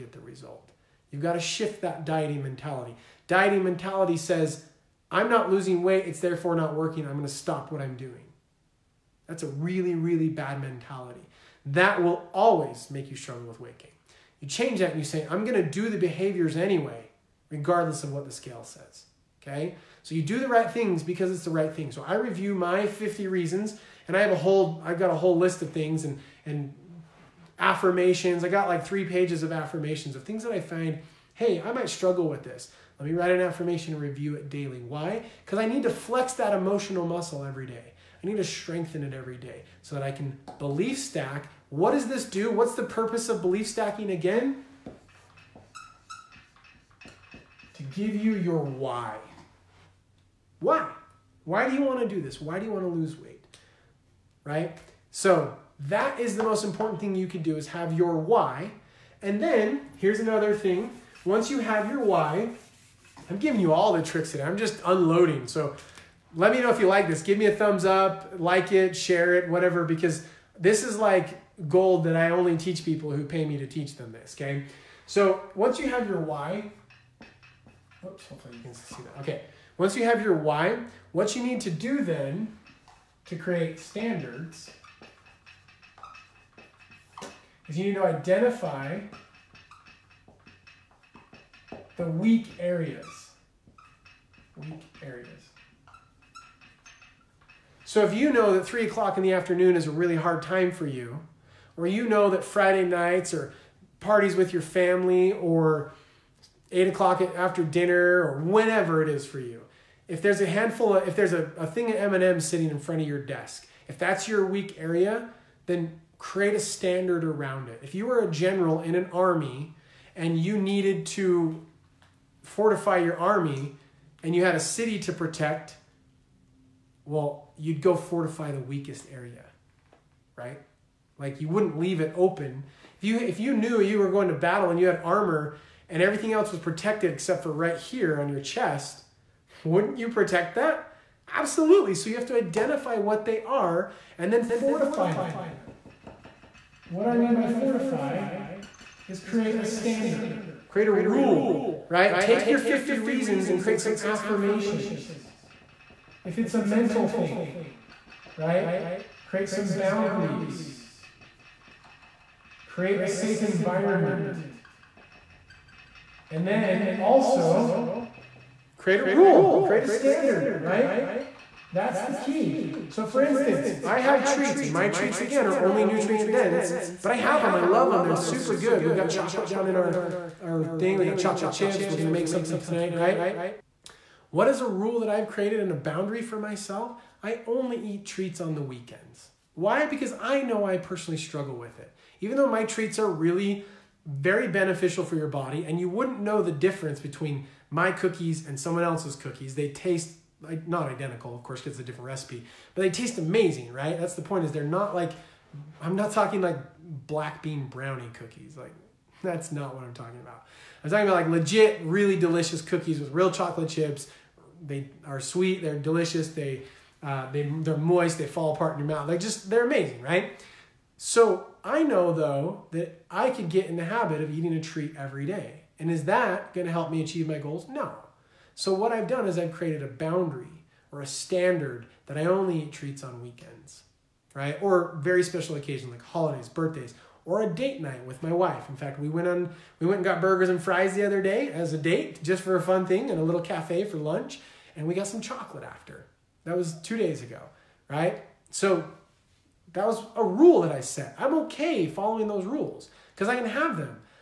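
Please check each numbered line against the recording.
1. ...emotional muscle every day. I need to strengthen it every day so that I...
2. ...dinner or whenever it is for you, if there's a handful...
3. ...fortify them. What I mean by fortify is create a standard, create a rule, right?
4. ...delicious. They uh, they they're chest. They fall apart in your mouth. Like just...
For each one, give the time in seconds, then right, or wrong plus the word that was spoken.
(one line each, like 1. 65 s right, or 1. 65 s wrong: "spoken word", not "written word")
1. 36 s right
2. 107 s right
3. 144 s right
4. 215 s wrong: "moist", not "chest".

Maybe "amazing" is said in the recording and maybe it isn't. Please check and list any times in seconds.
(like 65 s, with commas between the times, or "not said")
203 s, 219 s.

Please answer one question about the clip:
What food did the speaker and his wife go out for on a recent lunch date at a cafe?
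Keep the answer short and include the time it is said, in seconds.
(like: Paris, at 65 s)
Burgers and fries, at 240 s.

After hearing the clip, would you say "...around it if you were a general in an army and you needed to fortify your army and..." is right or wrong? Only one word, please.
right.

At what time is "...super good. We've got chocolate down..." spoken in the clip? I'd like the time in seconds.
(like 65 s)
178 s.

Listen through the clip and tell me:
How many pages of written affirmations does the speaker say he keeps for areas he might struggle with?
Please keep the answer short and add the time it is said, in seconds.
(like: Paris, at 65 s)
3, at 28 s.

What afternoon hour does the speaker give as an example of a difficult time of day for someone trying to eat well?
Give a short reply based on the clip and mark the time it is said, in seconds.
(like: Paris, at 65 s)
3 o'clock, at 98 s.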